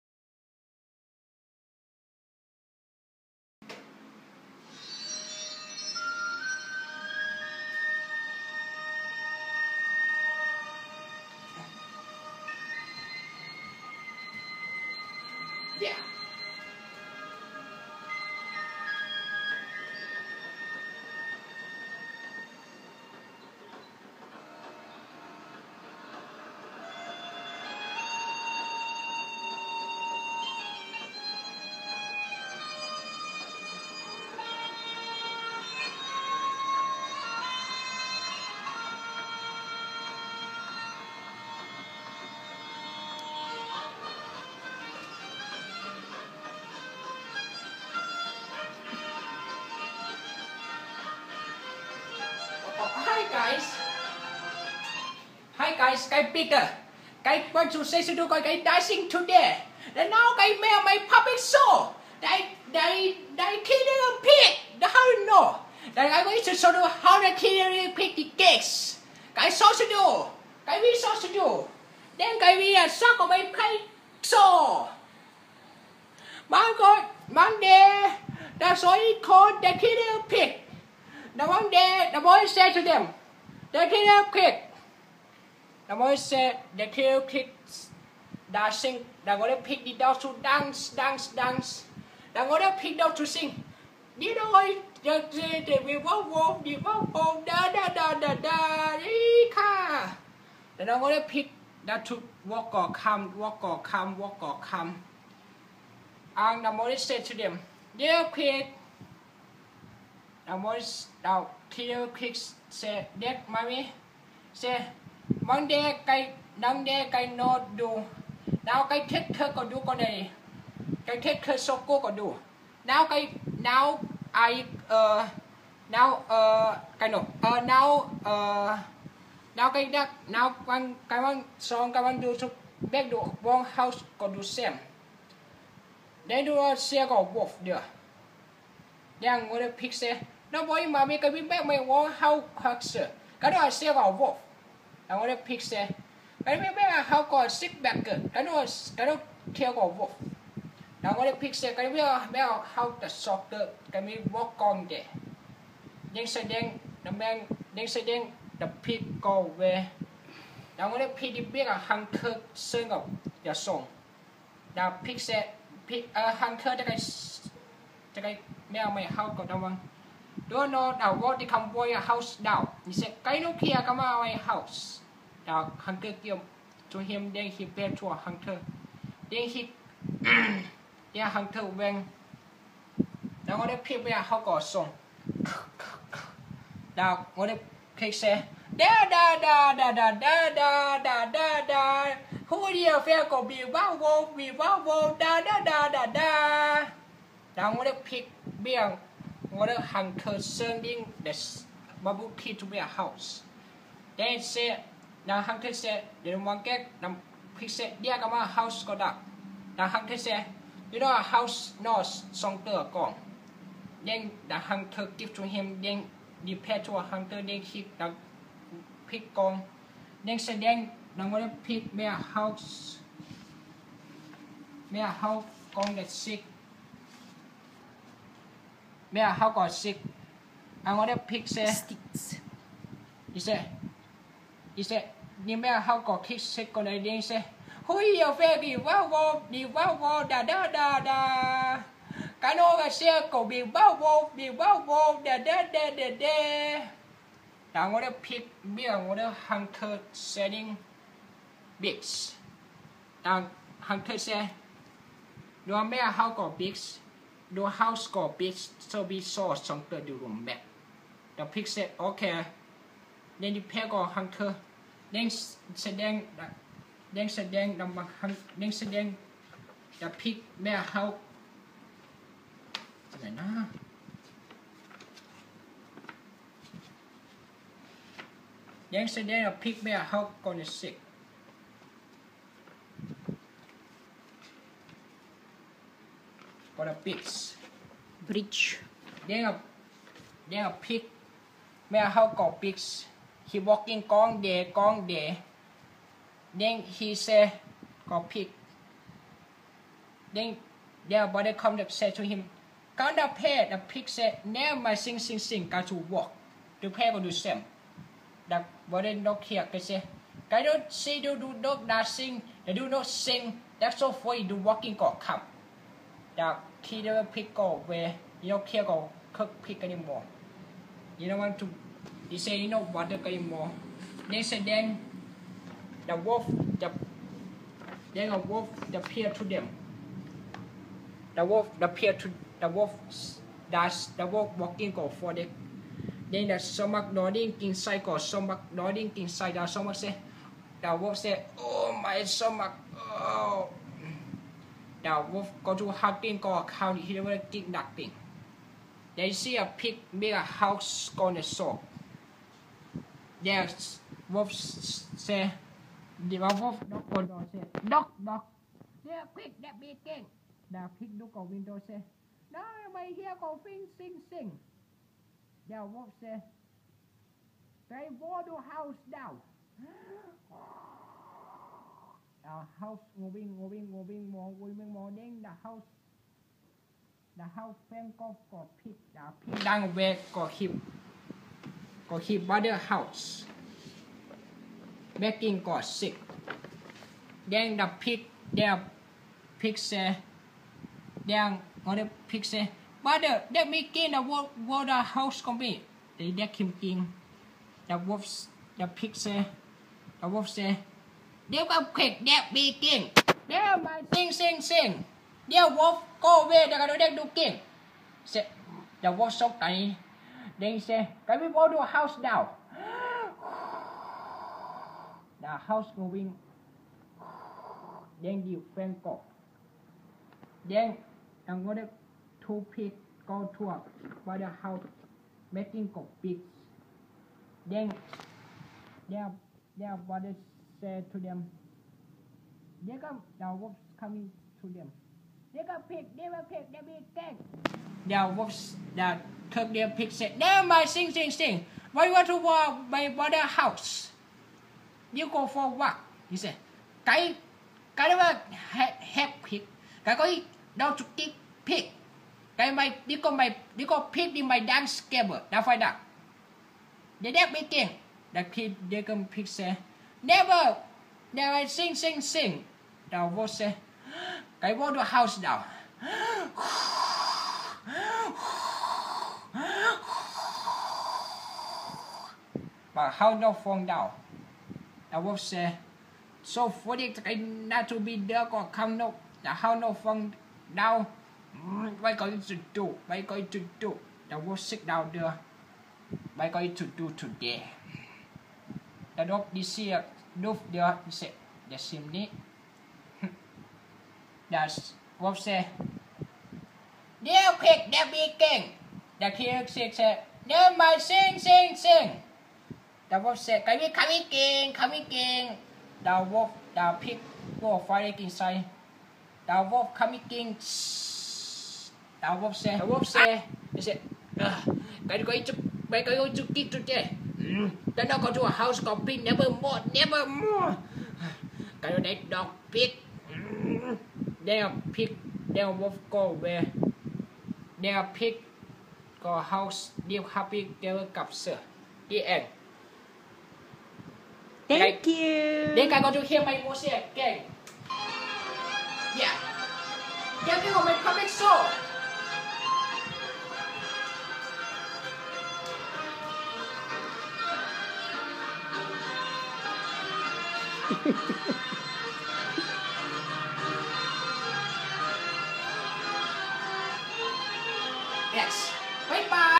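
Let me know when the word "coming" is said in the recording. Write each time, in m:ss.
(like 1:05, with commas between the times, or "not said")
7:14.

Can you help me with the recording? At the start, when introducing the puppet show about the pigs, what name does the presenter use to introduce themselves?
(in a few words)
Peter.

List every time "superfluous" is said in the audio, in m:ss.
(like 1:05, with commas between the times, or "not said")
not said.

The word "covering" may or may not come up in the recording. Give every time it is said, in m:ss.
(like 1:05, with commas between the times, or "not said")
not said.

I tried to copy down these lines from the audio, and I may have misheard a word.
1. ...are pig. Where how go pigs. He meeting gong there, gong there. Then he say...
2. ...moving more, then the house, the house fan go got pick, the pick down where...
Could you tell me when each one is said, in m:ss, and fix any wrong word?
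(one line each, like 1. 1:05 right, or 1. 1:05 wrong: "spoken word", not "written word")
1. 4:50 wrong: "walking", not "meeting"
2. 6:14 right.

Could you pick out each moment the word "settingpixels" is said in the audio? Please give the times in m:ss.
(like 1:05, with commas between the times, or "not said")
4:10.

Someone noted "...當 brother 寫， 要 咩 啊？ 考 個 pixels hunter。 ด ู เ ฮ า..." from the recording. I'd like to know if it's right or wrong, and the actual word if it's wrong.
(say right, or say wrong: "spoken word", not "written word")
wrong: "hunter", not "brother".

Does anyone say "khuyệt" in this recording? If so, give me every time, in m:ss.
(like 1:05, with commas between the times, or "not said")
6:41.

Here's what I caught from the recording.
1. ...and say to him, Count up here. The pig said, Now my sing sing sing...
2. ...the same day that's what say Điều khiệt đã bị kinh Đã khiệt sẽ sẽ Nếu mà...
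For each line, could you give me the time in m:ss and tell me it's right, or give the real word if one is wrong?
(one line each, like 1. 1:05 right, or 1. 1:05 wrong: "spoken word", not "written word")
1. 5:01 right
2. 8:11 right.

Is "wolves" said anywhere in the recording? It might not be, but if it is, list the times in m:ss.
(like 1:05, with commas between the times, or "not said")
7:13, 7:18.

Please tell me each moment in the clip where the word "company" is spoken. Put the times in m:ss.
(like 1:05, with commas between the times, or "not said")
6:35.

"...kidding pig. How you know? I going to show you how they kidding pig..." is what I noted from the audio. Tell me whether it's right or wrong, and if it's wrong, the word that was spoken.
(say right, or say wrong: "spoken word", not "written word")
right.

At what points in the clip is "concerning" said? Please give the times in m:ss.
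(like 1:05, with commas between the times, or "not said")
3:20.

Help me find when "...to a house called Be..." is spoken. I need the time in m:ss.
8:38.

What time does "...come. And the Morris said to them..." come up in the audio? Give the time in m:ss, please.
1:44.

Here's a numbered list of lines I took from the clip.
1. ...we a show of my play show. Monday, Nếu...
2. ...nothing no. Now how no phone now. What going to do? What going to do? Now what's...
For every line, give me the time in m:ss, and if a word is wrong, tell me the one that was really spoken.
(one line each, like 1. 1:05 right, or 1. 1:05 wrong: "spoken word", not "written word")
1. 1:12 wrong: "Monday", not "Nếu"
2. 7:58 wrong: "không", not "nothing".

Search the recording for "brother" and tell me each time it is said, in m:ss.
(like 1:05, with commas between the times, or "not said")
6:33, 7:23.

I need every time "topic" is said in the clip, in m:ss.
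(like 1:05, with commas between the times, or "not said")
not said.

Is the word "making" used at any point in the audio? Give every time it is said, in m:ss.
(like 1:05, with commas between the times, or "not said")
6:25, 7:05.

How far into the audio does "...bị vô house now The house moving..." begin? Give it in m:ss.
6:51.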